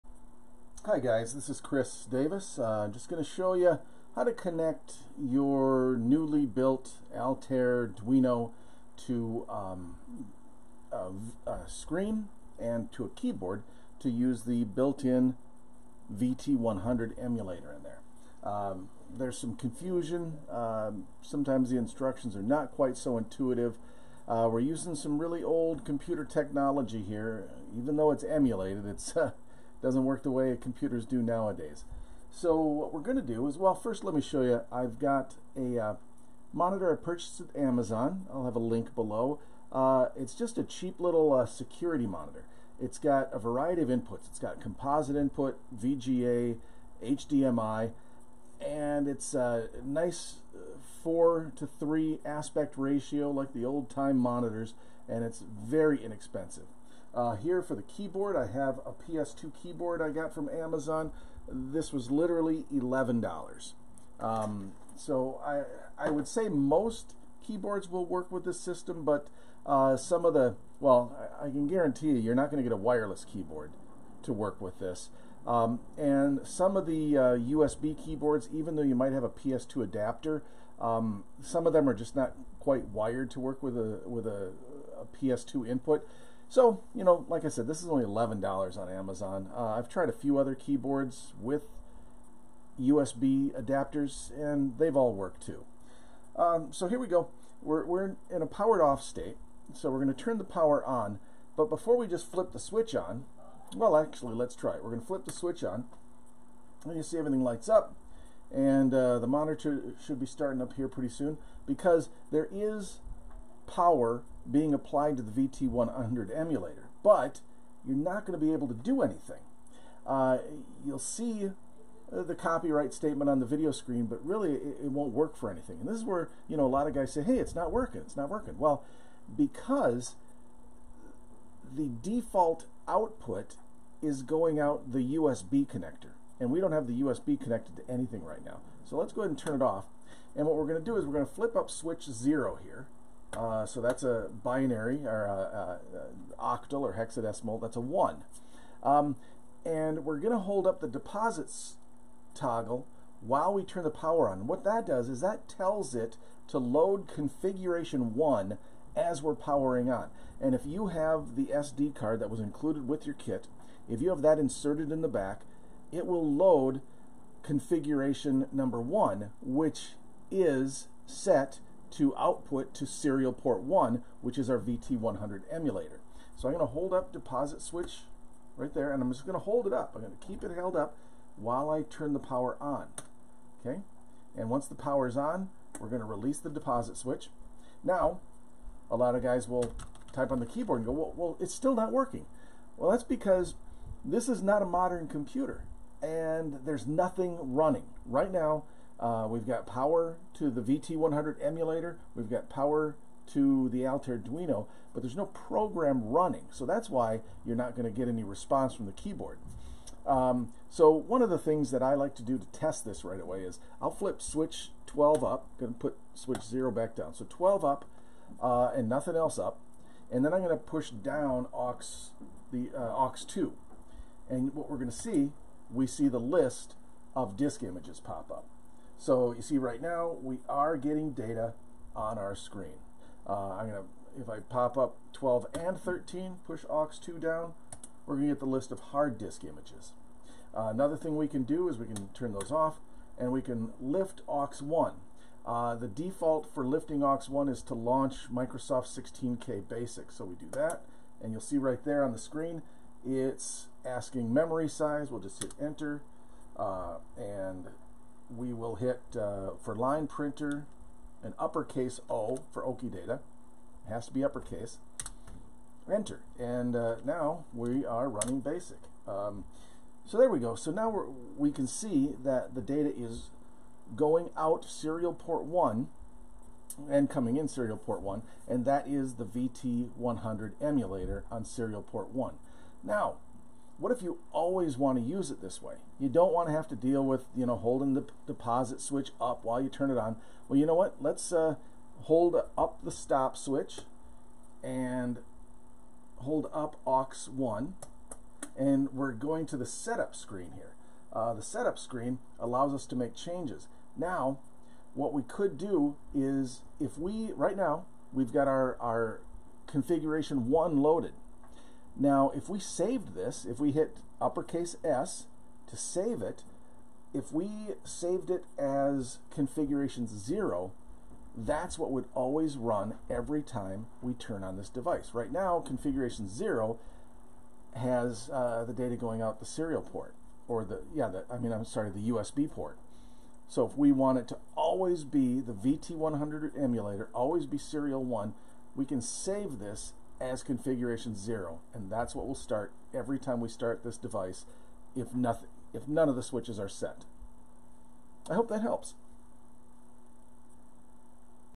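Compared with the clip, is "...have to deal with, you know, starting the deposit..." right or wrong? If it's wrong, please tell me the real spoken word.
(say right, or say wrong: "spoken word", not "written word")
wrong: "holding", not "starting".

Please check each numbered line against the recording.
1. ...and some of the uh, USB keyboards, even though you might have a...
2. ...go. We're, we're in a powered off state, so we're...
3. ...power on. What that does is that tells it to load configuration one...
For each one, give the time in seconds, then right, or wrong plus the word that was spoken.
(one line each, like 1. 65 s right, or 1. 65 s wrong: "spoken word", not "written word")
1. 75 s right
2. 97 s right
3. 153 s right.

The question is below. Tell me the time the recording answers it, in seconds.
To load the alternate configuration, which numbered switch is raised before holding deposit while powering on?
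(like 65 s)
141 s.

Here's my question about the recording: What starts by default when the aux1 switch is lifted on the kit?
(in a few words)
Microsoft 16K Basic.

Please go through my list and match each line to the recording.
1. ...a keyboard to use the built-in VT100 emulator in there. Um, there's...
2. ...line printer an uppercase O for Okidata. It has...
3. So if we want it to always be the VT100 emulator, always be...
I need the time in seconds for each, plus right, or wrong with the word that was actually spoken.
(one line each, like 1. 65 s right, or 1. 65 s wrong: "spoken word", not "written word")
1. 13 s right
2. 259 s right
3. 333 s right.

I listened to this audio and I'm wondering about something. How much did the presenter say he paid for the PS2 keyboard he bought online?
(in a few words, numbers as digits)
$11.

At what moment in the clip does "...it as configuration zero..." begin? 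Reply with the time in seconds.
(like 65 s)
318 s.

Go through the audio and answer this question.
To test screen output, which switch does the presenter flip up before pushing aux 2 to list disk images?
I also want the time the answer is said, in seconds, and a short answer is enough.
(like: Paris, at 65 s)
Switch 12, at 214 s.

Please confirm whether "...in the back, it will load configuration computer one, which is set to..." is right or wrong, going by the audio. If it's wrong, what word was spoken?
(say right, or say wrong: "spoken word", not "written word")
wrong: "number", not "computer".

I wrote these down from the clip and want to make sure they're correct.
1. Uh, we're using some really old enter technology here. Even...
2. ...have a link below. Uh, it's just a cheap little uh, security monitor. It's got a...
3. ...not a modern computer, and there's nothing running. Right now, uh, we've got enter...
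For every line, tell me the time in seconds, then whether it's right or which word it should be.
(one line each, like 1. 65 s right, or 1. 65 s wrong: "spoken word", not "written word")
1. 24 s wrong: "computer", not "enter"
2. 38 s right
3. 194 s wrong: "power", not "enter".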